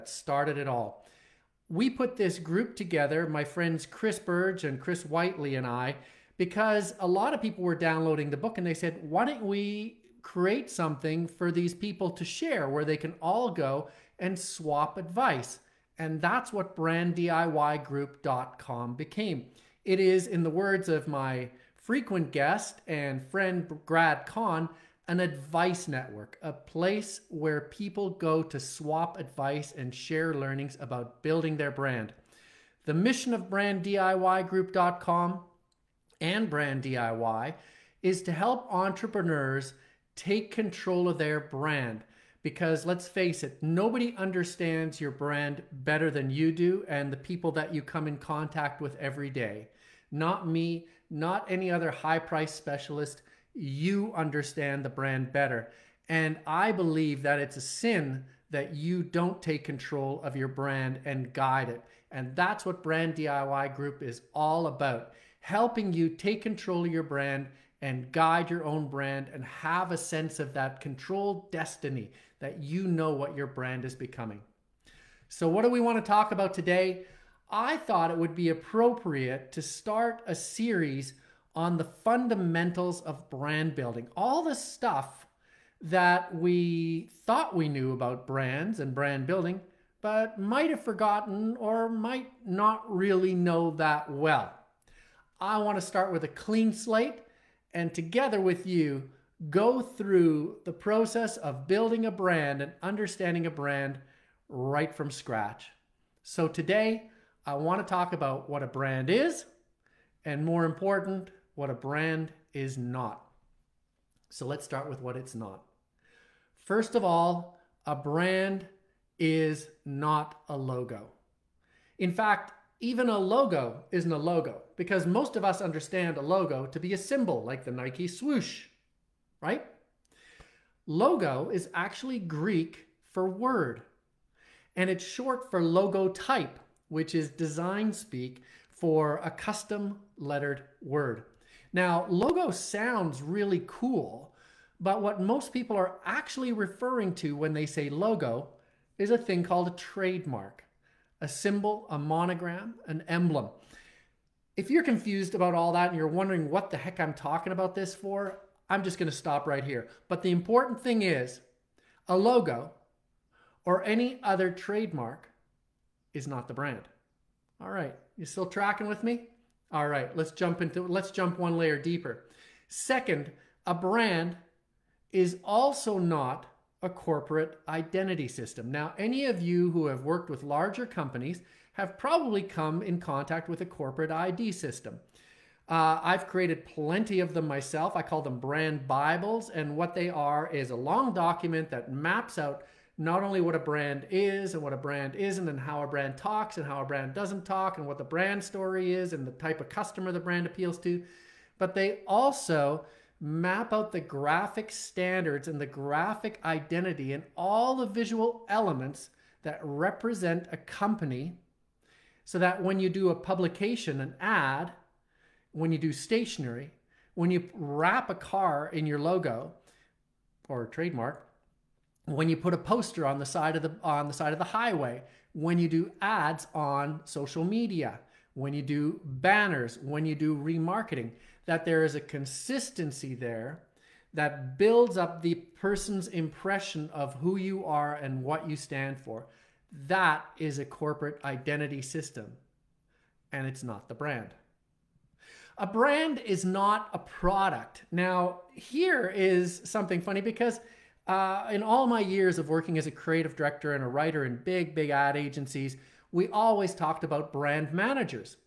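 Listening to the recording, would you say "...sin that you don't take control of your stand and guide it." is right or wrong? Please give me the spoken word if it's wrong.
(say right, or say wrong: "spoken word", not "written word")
wrong: "brand", not "stand".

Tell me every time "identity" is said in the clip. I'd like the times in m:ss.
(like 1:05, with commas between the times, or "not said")
2:57, 3:26, 4:01.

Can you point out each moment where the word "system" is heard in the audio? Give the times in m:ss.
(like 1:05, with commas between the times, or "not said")
2:58, 3:04, 4:01.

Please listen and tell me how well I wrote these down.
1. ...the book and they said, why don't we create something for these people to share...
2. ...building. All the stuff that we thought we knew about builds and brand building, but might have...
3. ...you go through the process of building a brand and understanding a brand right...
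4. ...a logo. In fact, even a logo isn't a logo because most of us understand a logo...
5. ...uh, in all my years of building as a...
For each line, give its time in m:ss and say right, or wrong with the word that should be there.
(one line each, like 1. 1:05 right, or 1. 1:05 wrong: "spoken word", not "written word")
1. 0:08 right
2. 1:23 wrong: "brands", not "builds"
3. 1:38 right
4. 2:00 right
5. 4:11 wrong: "working", not "building".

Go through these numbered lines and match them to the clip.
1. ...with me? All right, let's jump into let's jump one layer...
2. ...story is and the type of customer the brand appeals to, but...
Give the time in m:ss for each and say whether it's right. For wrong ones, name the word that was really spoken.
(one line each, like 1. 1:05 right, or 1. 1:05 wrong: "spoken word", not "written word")
1. 2:48 right
2. 3:18 right.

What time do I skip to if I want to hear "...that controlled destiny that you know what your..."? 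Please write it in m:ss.
1:10.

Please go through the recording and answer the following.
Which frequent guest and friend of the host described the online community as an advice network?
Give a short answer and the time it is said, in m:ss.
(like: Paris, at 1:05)
Brad Kahn, at 0:23.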